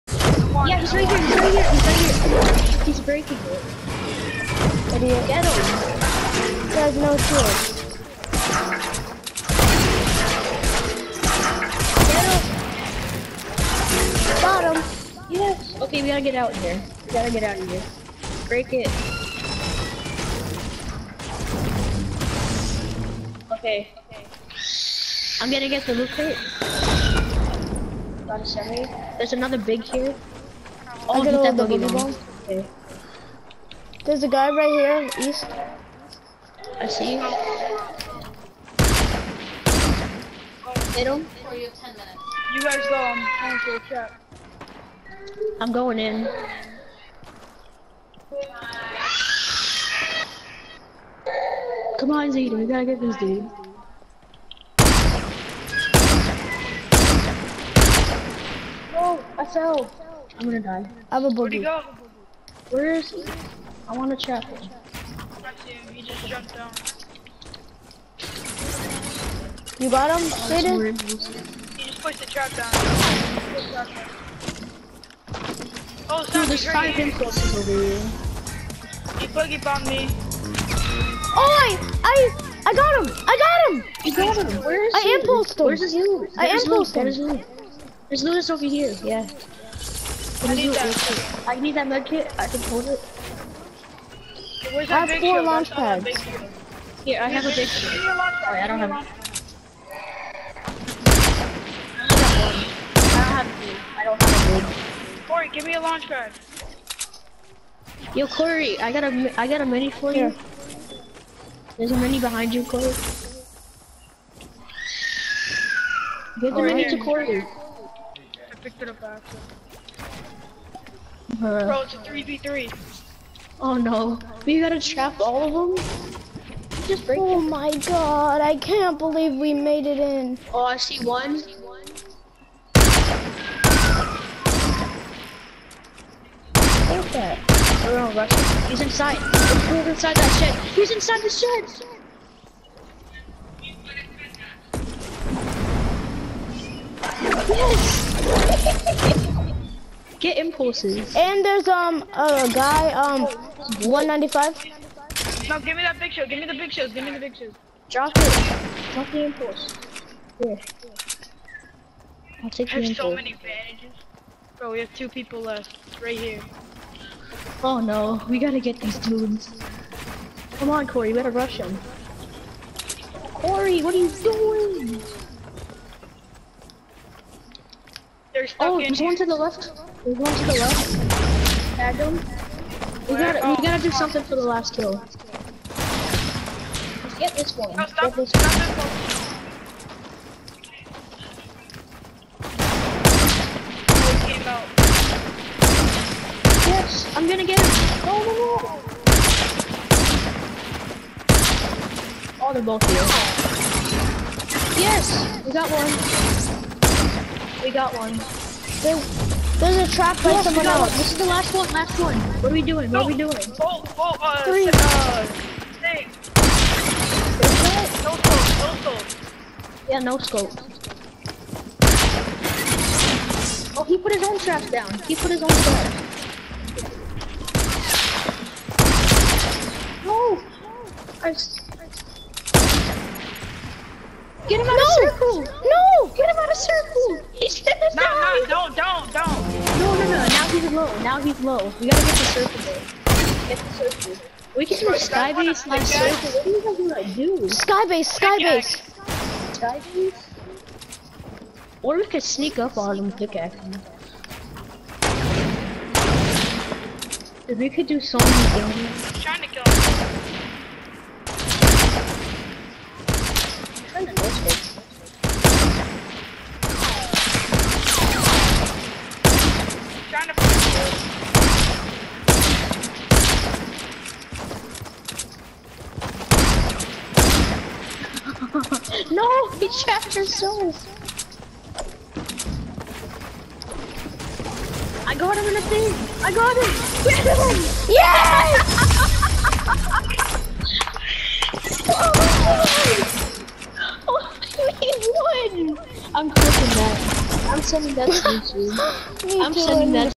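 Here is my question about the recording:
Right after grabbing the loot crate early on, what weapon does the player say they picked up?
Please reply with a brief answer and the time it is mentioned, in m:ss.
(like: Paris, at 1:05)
Semi, at 0:28.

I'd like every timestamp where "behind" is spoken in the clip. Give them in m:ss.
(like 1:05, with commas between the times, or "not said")
1:52.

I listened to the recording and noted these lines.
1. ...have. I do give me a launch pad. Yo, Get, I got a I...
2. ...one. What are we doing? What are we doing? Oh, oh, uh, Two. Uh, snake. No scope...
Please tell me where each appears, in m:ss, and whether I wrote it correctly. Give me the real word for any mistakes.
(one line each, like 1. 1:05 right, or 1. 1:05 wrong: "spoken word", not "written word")
1. 1:38 wrong: "Cory", not "Get"
2. 3:31 wrong: "Three", not "Two".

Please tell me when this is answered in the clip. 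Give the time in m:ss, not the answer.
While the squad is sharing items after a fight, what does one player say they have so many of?
2:42.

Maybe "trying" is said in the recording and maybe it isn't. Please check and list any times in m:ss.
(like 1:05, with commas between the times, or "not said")
0:43, 4:19.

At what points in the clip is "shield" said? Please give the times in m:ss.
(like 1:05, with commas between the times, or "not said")
0:07, 1:37.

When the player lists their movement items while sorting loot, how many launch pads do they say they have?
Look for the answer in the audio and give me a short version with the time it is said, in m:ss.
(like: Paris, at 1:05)
4, at 1:34.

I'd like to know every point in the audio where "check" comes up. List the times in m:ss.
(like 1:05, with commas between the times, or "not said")
0:43.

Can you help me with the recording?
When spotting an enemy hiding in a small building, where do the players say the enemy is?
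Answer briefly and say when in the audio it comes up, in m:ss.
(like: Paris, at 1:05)
Inside the shed, at 2:20.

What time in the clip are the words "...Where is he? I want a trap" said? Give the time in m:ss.
1:02.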